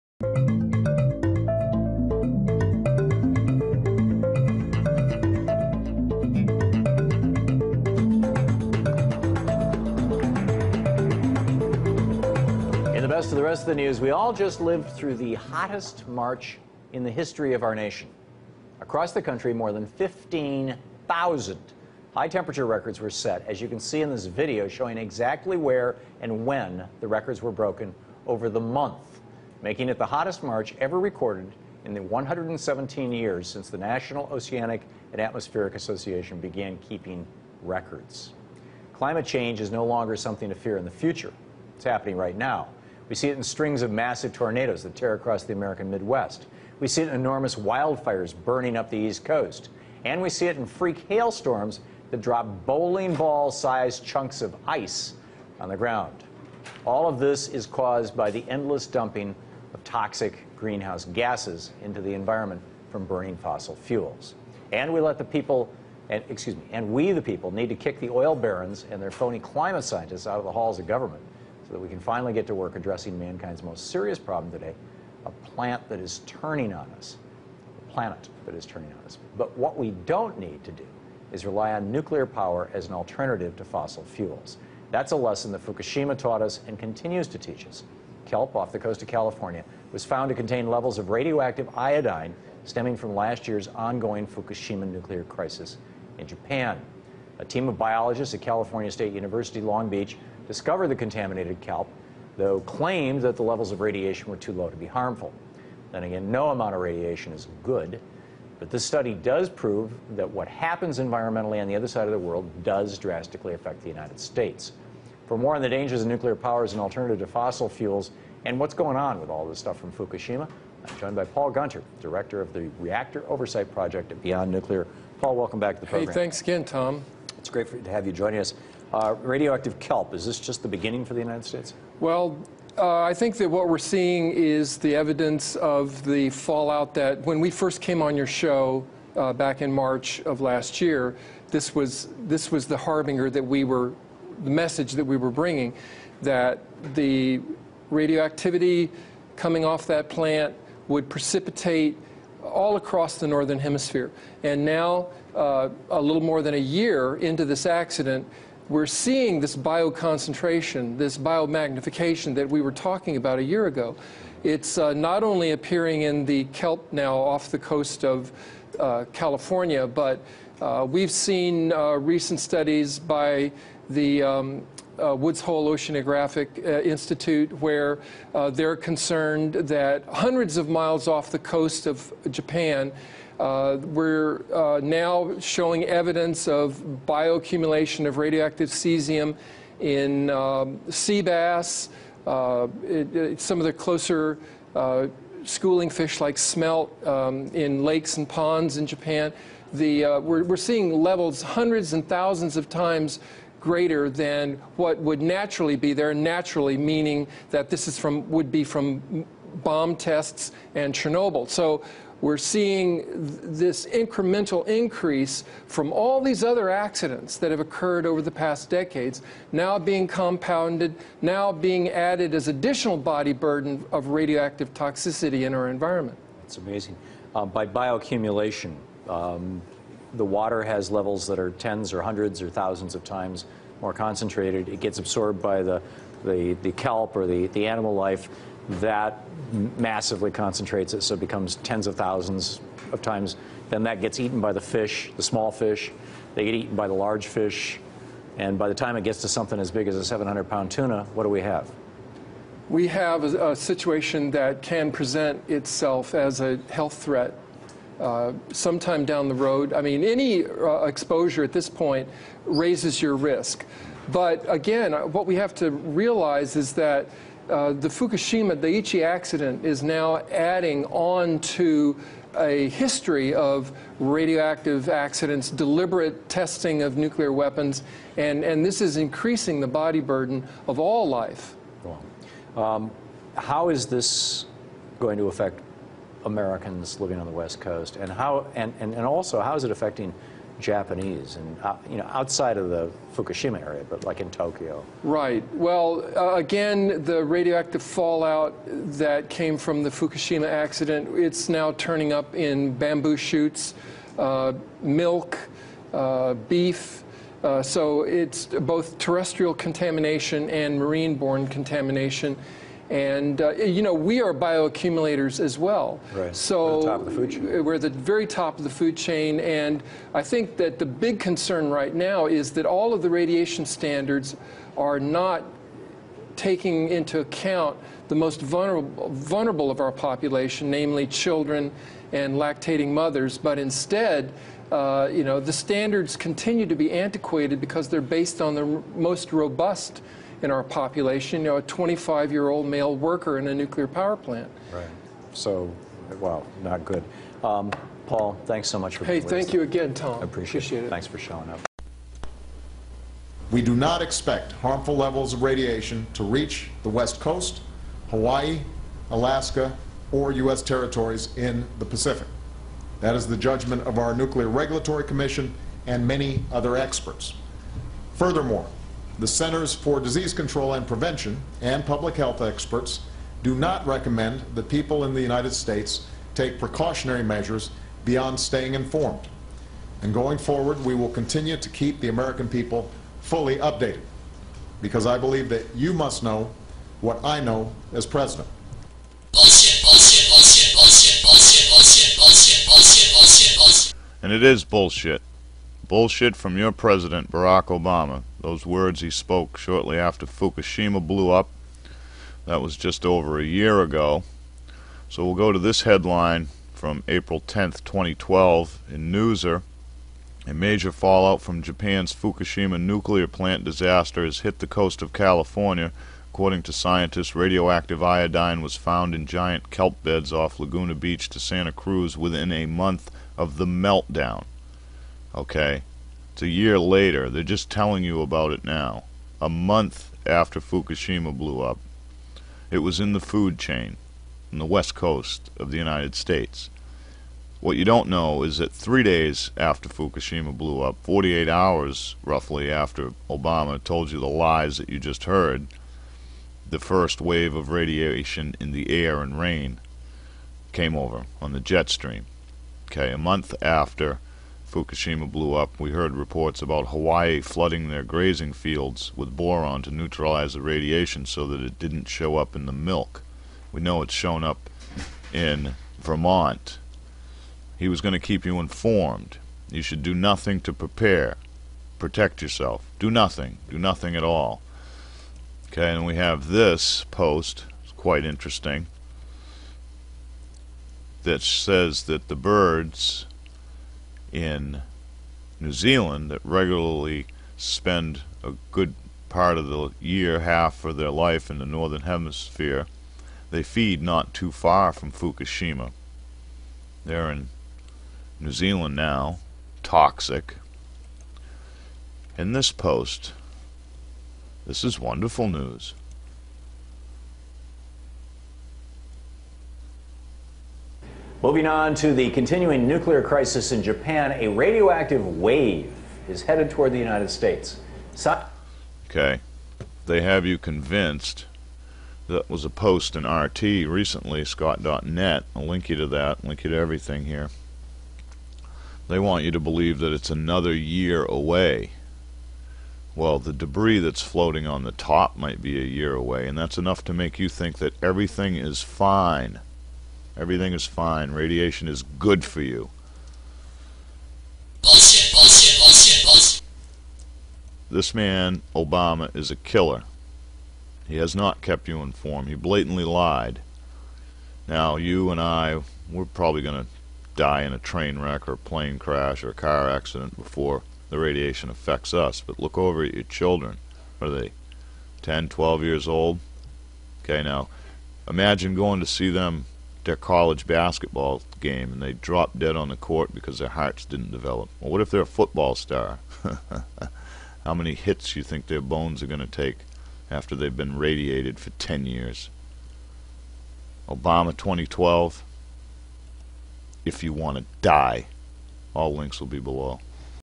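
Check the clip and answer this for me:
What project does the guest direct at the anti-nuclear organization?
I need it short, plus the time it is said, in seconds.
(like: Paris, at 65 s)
Reactor Oversight Project, at 122 s.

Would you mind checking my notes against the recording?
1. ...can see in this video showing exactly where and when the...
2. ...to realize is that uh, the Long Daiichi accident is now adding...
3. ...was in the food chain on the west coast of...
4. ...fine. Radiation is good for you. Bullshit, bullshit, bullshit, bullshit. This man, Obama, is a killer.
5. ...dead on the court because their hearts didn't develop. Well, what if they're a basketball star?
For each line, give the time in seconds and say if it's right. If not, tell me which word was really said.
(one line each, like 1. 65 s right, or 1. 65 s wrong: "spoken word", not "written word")
1. 23 s right
2. 265 s wrong: "Fukushima", not "Long"
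3. 432 s right
4. 540 s right
5. 572 s wrong: "football", not "basketball".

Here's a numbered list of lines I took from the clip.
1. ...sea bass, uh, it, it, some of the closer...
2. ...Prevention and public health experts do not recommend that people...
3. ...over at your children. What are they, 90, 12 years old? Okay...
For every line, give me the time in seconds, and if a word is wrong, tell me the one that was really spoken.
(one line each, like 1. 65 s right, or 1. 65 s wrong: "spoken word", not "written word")
1. 190 s right
2. 370 s right
3. 562 s wrong: "10", not "90".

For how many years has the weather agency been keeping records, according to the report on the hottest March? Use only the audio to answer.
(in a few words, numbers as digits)
117.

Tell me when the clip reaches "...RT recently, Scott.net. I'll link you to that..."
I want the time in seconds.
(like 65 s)
523 s.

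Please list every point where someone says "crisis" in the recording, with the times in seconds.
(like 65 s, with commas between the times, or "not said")
95 s, 513 s.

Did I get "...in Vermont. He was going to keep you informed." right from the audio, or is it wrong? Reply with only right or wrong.
right.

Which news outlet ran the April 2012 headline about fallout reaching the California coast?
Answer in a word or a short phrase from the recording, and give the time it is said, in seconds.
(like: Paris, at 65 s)
Newser, at 409 s.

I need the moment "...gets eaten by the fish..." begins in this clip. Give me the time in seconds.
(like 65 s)
244 s.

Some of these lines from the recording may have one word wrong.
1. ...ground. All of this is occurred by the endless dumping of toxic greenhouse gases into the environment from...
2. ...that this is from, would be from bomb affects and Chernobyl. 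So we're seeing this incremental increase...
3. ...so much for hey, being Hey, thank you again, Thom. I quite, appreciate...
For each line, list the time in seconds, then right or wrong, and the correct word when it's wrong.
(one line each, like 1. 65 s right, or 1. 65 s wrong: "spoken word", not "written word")
1. 55 s wrong: "caused", not "occurred"
2. 207 s wrong: "tests", not "affects"
3. 348 s wrong: "appreciate", not "quite".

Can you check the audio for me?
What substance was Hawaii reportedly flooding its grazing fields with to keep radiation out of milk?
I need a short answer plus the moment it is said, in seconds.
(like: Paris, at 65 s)
Boron, at 459 s.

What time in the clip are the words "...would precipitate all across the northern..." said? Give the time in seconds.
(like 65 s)
150 s.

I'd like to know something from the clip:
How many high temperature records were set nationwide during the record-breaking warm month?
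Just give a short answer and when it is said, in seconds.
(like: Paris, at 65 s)
15,000, at 19 s.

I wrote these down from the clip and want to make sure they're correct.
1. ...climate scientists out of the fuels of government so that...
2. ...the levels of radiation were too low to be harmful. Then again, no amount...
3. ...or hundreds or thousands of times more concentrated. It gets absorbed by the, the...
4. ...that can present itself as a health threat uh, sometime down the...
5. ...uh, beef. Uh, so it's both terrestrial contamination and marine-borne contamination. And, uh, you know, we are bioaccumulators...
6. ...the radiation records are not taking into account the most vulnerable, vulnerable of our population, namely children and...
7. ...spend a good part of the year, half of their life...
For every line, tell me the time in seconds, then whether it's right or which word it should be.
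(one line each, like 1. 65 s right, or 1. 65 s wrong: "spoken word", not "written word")
1. 69 s wrong: "halls", not "fuels"
2. 103 s right
3. 231 s right
4. 254 s right
5. 305 s right
6. 323 s wrong: "standards", not "records"
7. 487 s right.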